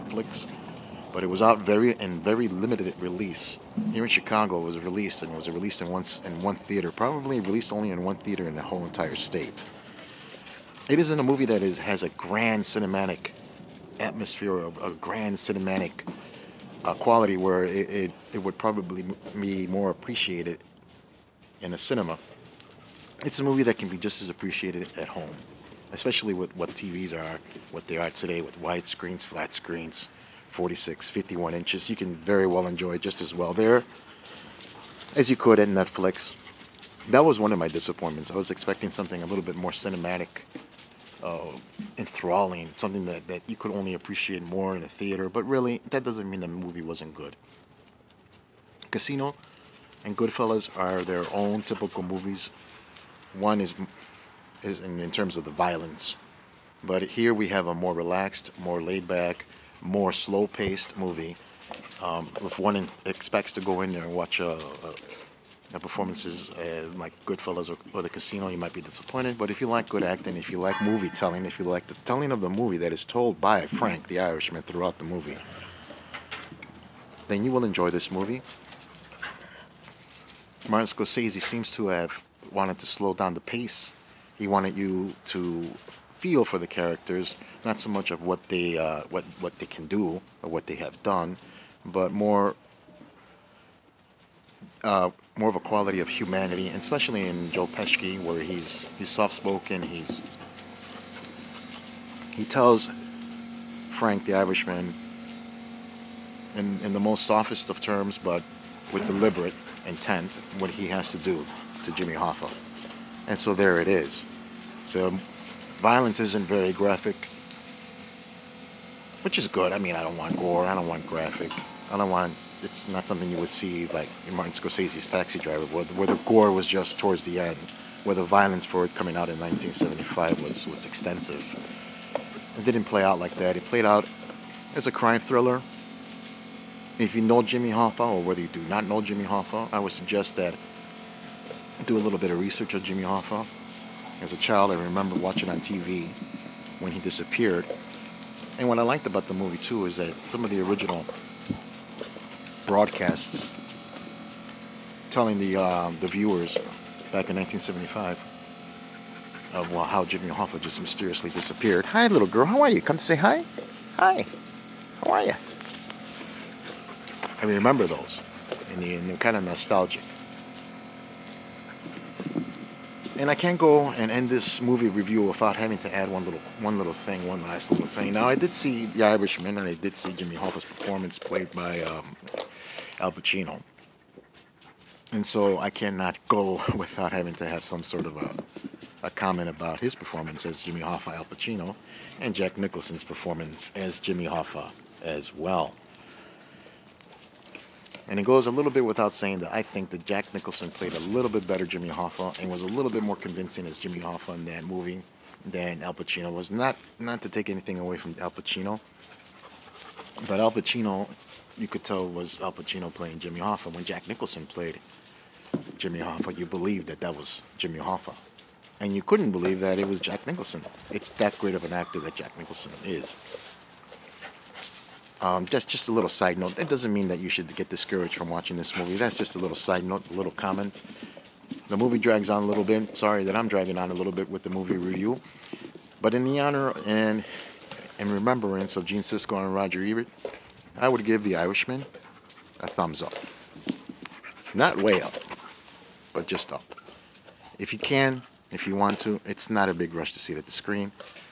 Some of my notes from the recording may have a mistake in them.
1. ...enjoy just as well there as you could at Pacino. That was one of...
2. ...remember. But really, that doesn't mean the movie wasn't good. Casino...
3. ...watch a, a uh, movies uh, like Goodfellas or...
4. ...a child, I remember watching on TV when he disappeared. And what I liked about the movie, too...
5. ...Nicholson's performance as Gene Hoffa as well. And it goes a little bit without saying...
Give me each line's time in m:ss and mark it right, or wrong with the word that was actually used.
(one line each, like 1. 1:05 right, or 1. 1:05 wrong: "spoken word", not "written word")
1. 0:32 wrong: "Netflix", not "Pacino"
2. 0:44 wrong: "theater", not "remember"
3. 1:04 wrong: "performances", not "movies"
4. 2:24 right
5. 3:12 wrong: "Jimmy", not "Gene".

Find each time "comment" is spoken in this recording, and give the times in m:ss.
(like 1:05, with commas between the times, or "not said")
3:09, 3:50.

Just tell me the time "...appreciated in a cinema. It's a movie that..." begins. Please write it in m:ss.
0:19.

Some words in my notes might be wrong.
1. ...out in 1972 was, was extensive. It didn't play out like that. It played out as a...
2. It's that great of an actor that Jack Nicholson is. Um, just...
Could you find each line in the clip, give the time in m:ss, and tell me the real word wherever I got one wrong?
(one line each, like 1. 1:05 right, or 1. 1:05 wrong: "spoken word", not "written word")
1. 2:09 wrong: "1975", not "1972"
2. 3:40 right.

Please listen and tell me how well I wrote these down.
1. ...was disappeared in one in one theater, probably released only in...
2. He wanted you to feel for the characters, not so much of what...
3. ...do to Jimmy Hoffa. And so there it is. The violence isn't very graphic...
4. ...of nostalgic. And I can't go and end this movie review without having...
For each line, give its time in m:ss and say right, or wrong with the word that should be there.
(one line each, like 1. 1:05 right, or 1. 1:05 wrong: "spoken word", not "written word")
1. 0:05 wrong: "released", not "disappeared"
2. 1:24 right
3. 1:51 right
4. 2:49 right.